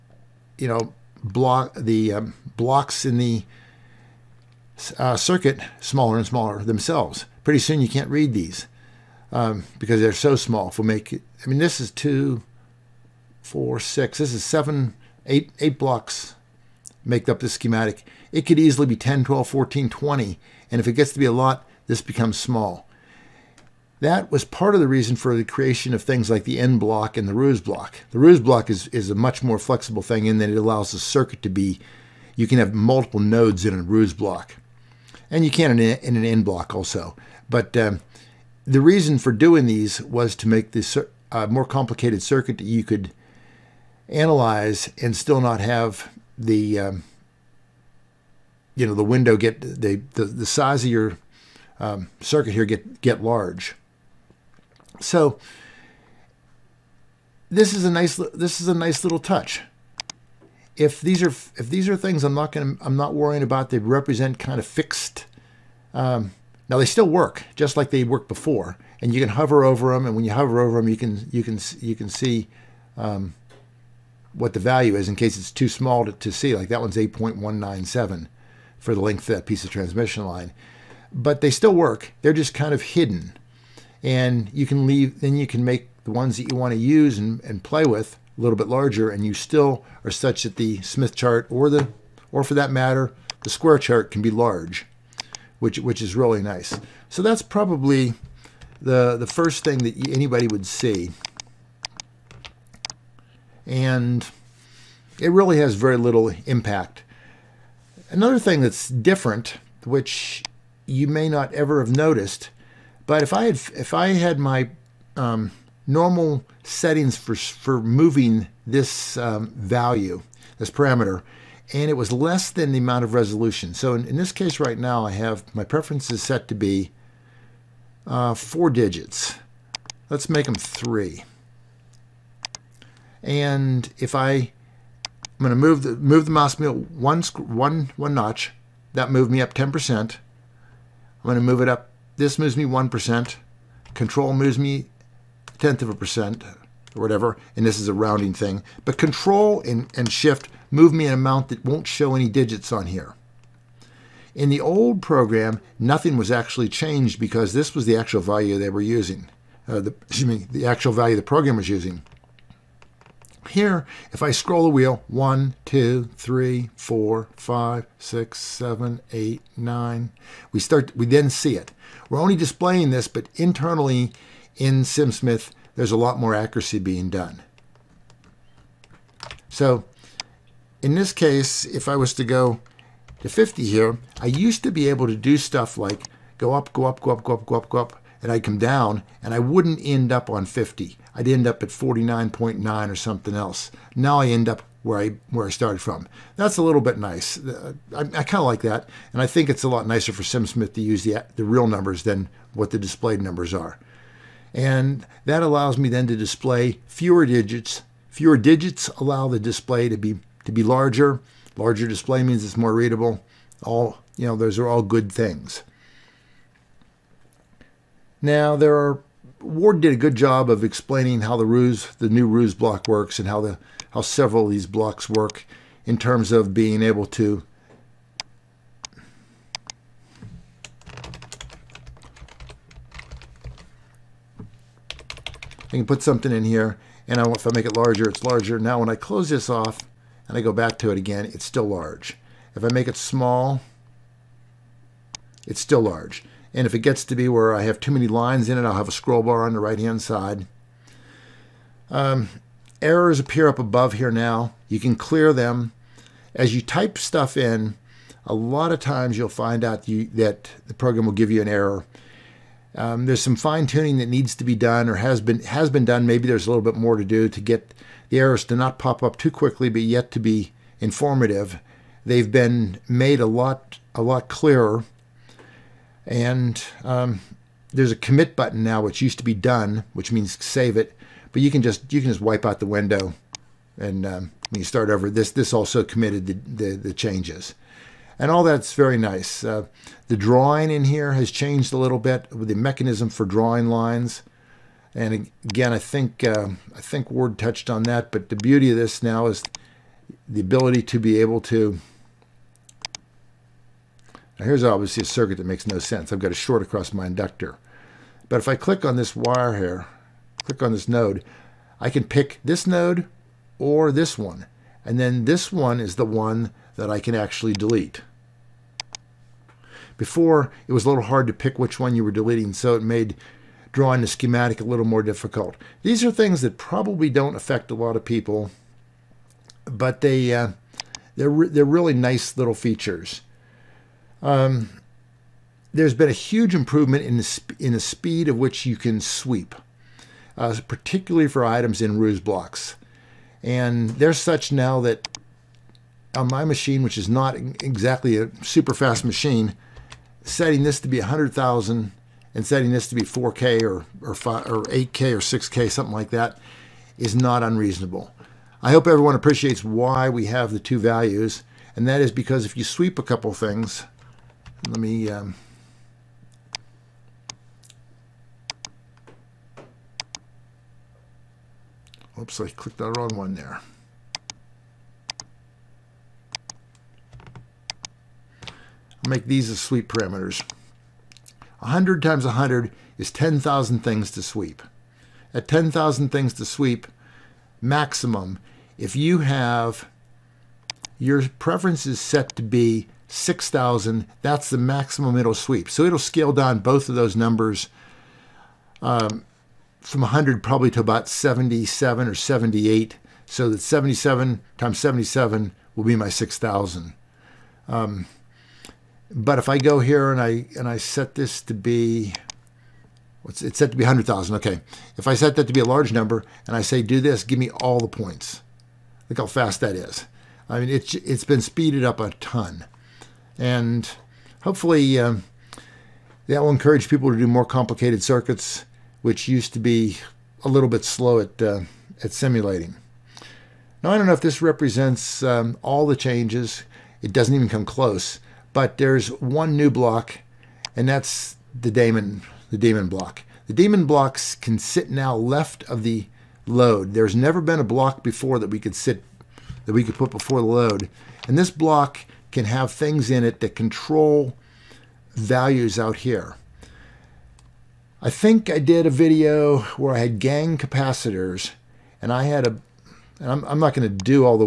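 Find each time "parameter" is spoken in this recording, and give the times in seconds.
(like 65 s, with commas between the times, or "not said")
120 s, 379 s.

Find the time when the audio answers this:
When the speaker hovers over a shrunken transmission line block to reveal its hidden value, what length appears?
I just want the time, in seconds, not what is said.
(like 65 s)
76 s.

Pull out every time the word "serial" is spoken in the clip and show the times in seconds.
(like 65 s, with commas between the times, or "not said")
not said.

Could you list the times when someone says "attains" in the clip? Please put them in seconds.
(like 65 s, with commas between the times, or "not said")
not said.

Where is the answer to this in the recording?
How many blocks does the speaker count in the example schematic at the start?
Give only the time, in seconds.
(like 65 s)
15 s.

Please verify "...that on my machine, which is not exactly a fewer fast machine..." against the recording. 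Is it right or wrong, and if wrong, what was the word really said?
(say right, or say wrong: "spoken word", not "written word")
wrong: "super", not "fewer".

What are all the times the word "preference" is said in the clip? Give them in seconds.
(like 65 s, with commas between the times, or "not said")
125 s, 391 s.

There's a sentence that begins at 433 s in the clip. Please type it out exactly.
Now, I don't know if this represents um, all the changes.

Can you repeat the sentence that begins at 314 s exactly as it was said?
And then this one is the one that I can actually delete.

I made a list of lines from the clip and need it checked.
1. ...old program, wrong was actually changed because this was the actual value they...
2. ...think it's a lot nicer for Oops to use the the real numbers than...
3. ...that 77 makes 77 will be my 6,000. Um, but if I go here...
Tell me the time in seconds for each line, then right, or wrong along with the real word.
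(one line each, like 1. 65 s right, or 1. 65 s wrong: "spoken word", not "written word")
1. 154 s wrong: "nothing", not "wrong"
2. 199 s wrong: "SimSmith", not "Oops"
3. 403 s wrong: "times", not "makes".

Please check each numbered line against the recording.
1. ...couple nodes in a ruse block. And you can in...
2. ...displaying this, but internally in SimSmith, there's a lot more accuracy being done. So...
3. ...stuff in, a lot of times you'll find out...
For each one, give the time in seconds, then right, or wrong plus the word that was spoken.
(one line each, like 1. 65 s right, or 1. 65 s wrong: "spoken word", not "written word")
1. 32 s wrong: "multiple", not "couple"
2. 172 s right
3. 256 s right.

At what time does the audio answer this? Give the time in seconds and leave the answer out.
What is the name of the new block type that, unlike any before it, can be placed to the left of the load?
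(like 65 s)
442 s.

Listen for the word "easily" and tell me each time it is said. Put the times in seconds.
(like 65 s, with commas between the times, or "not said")
18 s.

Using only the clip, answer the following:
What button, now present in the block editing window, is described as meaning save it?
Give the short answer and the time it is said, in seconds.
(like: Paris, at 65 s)
Commit, at 277 s.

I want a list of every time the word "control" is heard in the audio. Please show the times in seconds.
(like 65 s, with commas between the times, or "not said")
143 s, 148 s, 453 s.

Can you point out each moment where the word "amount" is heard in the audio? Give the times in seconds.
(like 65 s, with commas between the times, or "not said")
122 s, 151 s.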